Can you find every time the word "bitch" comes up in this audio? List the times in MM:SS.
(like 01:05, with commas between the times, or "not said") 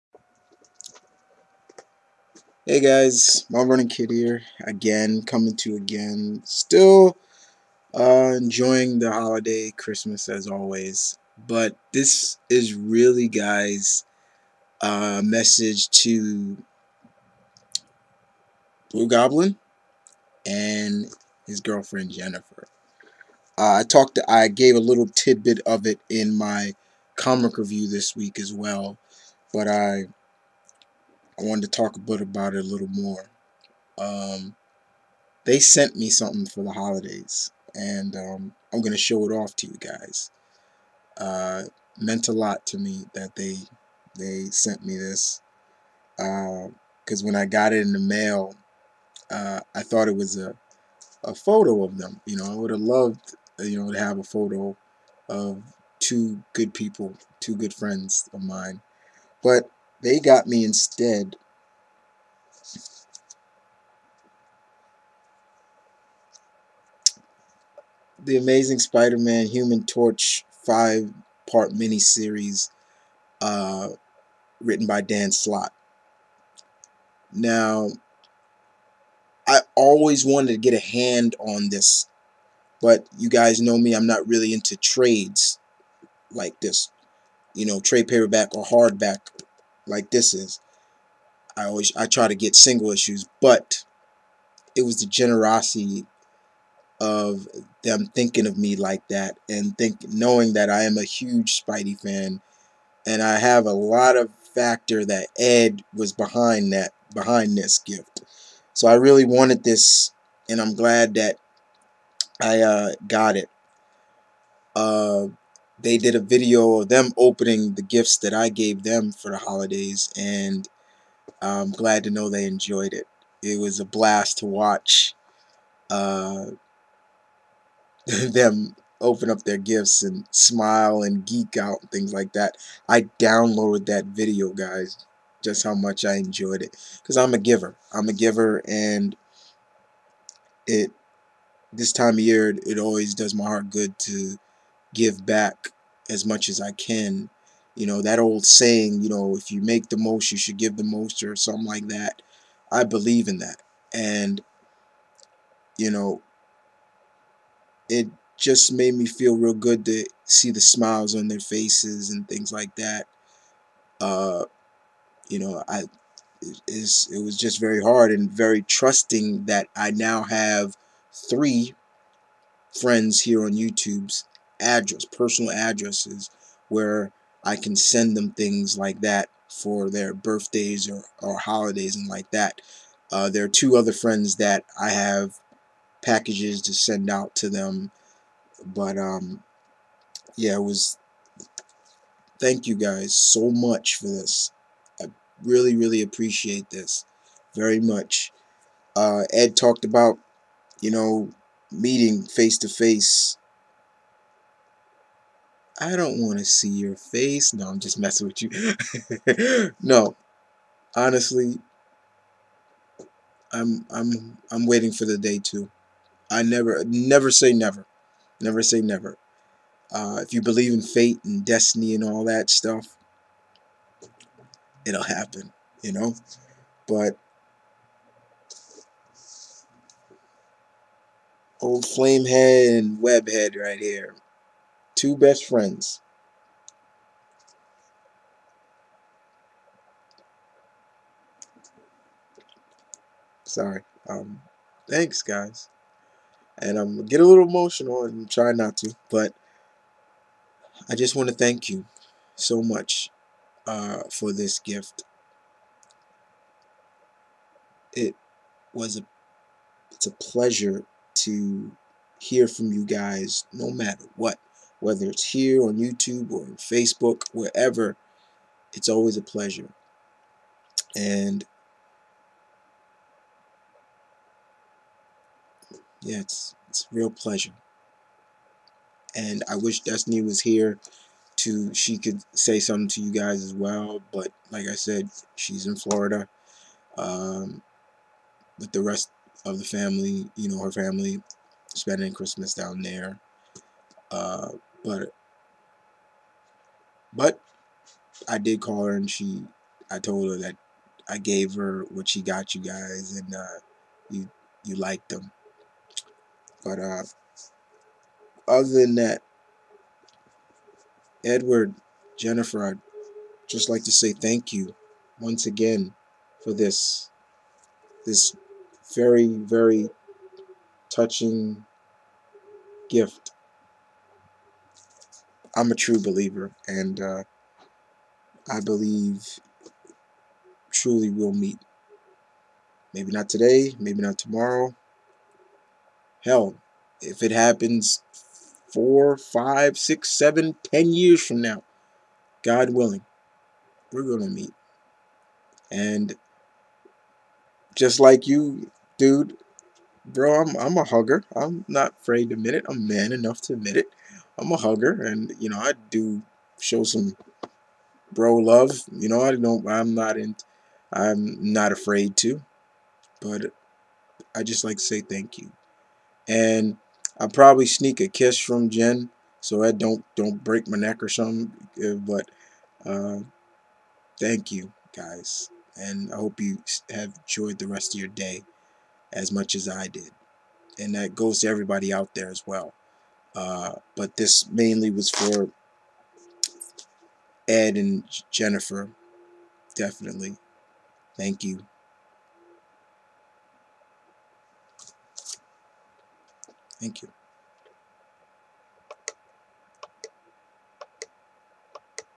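not said.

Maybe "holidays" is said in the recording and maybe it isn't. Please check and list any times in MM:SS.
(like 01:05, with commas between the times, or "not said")
00:09, 00:36, 01:59, 03:01.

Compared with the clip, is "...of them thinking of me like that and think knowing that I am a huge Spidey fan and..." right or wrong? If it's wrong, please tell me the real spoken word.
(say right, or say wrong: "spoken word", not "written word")
right.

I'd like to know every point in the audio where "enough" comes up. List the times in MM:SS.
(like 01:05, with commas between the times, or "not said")
05:53.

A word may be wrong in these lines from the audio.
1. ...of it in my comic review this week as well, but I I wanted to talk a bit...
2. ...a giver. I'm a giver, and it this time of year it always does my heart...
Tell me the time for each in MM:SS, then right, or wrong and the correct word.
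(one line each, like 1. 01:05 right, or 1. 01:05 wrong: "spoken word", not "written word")
1. 00:25 right
2. 02:17 right.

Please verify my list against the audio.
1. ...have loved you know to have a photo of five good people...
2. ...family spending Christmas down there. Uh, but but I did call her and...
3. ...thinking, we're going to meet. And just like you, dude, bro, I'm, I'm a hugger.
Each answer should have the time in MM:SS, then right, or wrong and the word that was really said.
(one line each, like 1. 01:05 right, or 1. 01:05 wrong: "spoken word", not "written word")
1. 00:52 wrong: "two", not "five"
2. 04:50 right
3. 05:42 wrong: "willing", not "thinking".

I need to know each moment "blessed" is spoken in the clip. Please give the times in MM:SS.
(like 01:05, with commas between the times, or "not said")
not said.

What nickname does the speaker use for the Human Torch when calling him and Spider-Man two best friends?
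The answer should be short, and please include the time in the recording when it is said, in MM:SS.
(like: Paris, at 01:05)
flamehead, at 03:51.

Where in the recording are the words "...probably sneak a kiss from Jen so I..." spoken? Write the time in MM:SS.
06:07.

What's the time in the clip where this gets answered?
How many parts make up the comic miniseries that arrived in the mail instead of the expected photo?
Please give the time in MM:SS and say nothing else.
01:10.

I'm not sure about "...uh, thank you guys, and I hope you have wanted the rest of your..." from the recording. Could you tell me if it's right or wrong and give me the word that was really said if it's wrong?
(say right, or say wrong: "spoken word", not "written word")
wrong: "enjoyed", not "wanted".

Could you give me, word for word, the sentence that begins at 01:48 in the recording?
So I really wanted this and I'm glad that I uh, got it.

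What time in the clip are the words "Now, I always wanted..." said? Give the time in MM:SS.
01:17.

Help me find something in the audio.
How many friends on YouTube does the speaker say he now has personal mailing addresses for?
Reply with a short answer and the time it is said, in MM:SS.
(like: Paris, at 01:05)
3, at 02:51.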